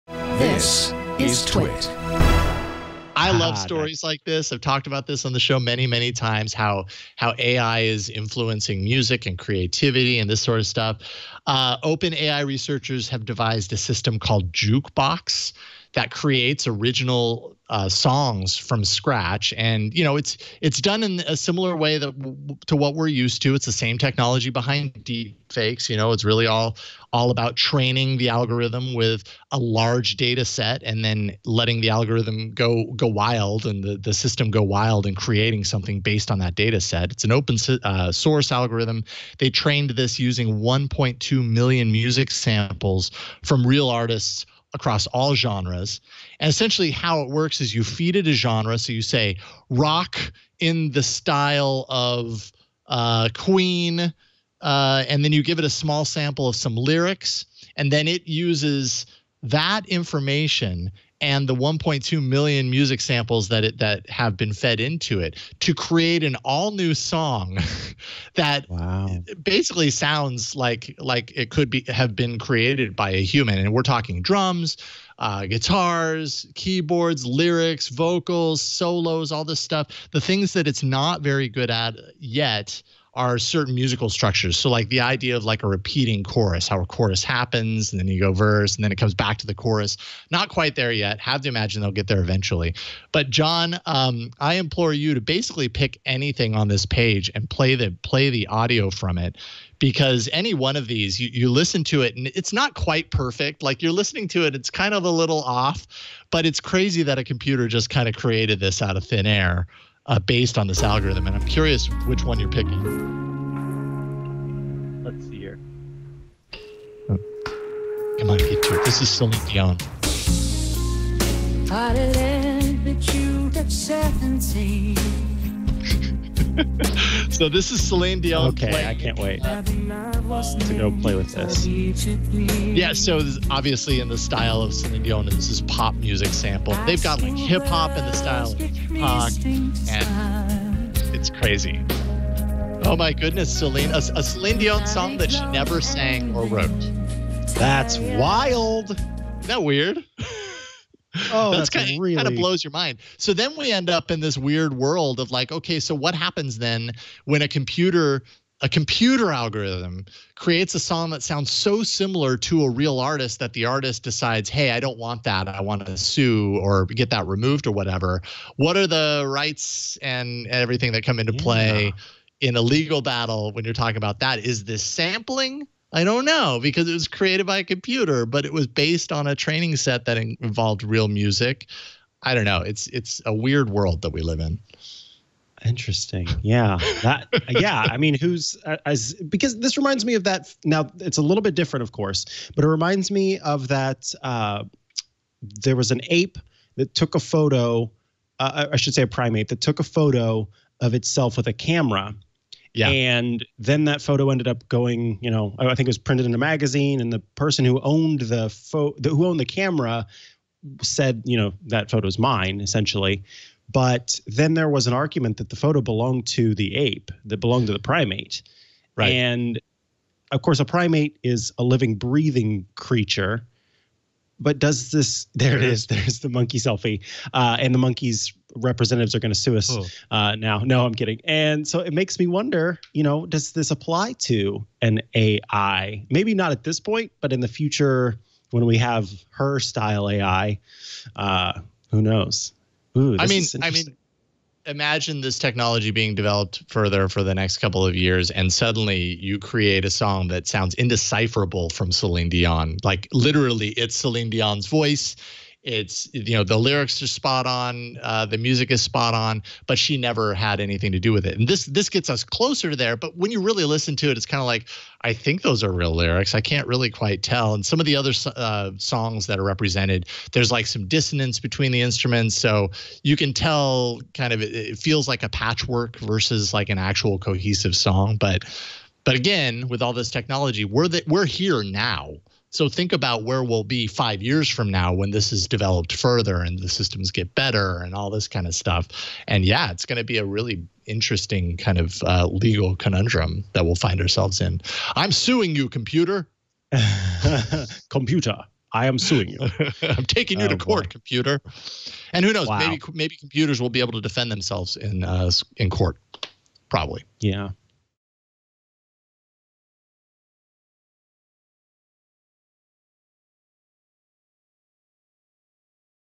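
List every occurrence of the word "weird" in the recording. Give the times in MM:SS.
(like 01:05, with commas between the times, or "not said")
02:29, 02:34, 03:03.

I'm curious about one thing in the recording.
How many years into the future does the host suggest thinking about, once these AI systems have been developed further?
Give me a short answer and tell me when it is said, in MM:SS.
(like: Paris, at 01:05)
5 years, at 04:43.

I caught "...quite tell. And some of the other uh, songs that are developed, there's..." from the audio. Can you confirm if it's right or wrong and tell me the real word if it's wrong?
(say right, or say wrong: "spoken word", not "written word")
wrong: "represented", not "developed".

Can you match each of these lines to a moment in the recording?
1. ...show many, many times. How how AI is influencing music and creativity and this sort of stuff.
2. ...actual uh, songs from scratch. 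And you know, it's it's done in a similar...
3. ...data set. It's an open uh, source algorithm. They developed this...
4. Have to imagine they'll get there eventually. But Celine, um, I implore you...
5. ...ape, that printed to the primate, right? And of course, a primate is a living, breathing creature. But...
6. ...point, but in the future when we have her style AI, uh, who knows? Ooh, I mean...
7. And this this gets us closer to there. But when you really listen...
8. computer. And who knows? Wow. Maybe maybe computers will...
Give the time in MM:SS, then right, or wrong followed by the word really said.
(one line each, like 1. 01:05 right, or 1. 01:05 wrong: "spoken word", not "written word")
1. 00:05 right
2. 00:16 wrong: "original", not "actual"
3. 00:36 wrong: "trained", not "developed"
4. 01:31 wrong: "John", not "Celine"
5. 03:36 wrong: "belonged", not "printed"
6. 03:56 right
7. 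04:21 right
8. 05:00 right.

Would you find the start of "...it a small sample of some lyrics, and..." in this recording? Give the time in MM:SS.
00:55.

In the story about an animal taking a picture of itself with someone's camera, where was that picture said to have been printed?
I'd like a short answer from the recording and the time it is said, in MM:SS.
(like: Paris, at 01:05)
A magazine, at 03:26.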